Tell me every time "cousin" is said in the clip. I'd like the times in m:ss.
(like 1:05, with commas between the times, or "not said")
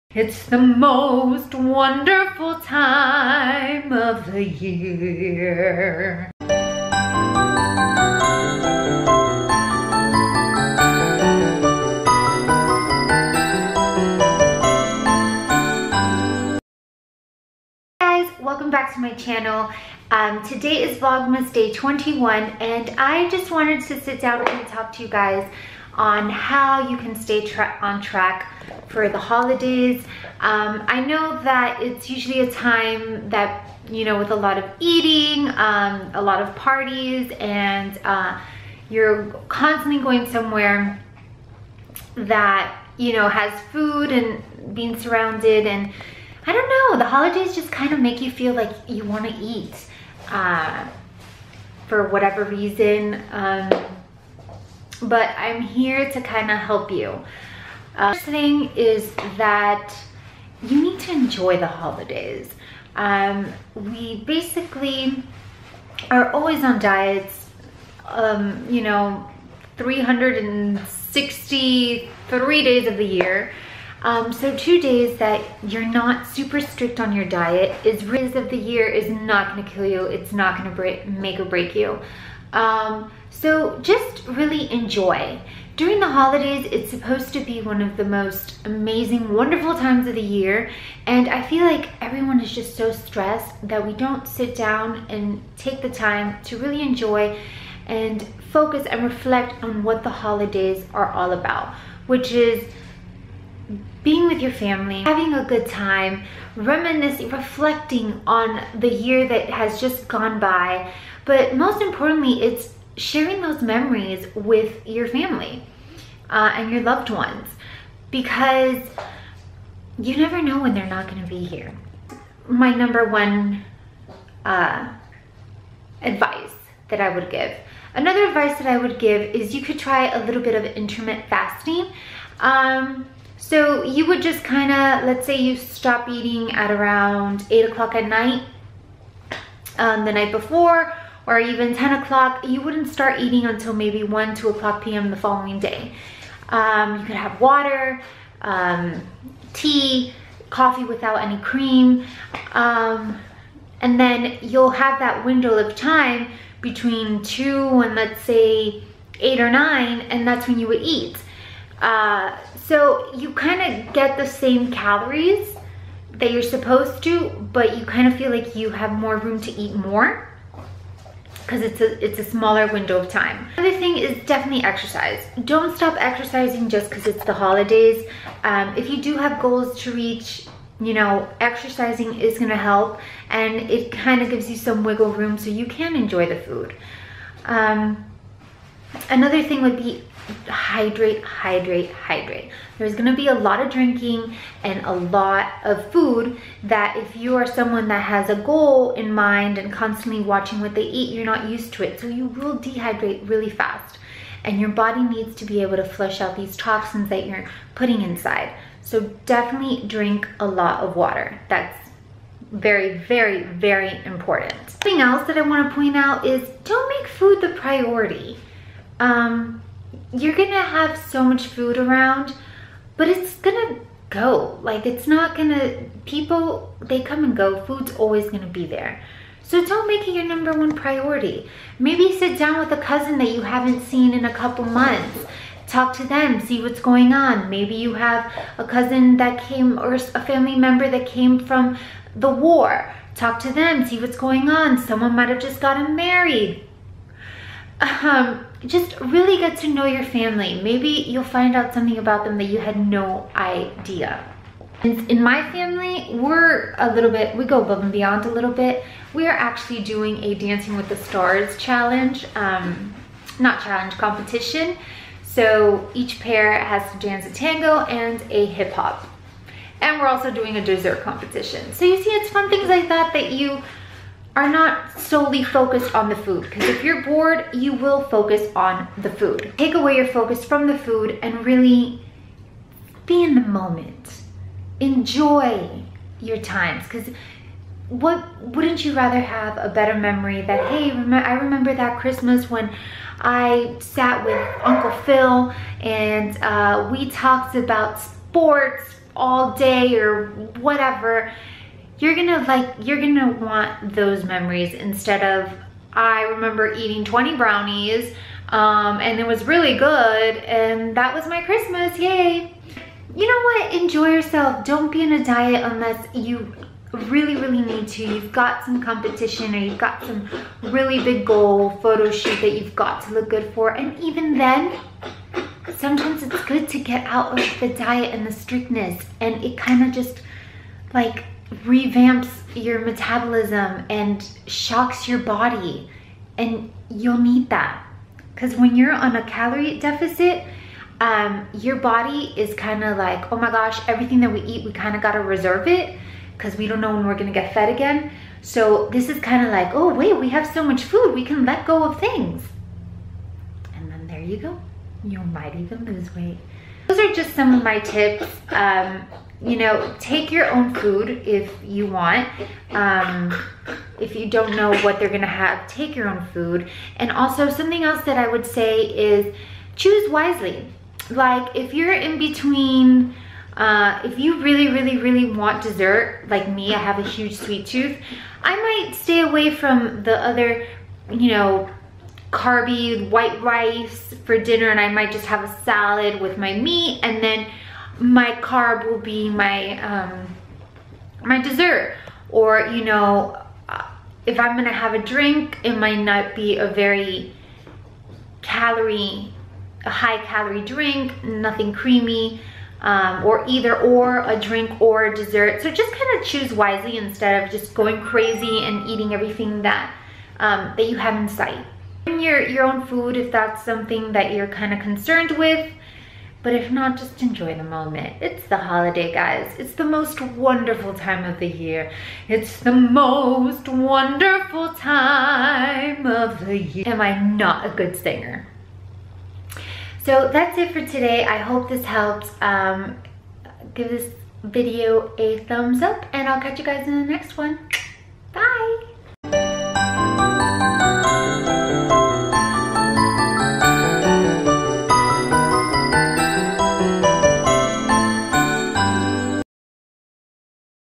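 3:52, 3:58.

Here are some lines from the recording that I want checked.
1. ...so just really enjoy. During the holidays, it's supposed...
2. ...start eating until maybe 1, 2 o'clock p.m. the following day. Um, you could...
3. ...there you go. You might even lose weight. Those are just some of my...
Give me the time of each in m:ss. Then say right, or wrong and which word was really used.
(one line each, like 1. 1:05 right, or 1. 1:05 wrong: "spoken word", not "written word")
1. 1:23 right
2. 2:22 right
3. 5:54 right.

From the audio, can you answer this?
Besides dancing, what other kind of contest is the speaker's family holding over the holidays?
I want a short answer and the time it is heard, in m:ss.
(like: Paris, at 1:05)
dessert competition, at 4:30.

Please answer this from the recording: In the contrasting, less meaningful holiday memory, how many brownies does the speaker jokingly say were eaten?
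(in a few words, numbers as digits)
20.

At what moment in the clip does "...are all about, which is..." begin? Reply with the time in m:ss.
1:40.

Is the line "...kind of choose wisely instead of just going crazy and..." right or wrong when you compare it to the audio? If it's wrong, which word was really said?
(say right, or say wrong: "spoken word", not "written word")
right.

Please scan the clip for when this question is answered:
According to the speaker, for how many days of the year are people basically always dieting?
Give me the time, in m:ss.
1:09.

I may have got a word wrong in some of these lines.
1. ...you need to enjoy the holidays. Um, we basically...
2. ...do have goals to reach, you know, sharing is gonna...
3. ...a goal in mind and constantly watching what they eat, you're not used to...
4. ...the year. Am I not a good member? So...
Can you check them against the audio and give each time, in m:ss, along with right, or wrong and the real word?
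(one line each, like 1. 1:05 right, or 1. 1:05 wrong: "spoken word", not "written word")
1. 1:00 right
2. 2:59 wrong: "exercising", not "sharing"
3. 3:18 right
4. 7:06 wrong: "singer", not "member".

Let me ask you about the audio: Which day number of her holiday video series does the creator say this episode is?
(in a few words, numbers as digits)
21.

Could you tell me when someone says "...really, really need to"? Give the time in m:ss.
5:16.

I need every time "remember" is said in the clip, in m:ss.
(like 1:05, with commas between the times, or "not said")
4:51, 5:06.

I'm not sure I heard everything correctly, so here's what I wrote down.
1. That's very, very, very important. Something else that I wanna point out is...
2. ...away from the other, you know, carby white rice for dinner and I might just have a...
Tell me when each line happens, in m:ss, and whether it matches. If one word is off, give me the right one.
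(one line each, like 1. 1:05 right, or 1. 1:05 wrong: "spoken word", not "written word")
1. 3:31 right
2. 6:19 right.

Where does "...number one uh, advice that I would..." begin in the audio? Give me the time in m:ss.
2:02.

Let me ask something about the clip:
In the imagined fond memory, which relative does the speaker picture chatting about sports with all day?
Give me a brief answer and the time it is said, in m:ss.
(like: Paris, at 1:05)
Uncle Phil, at 4:54.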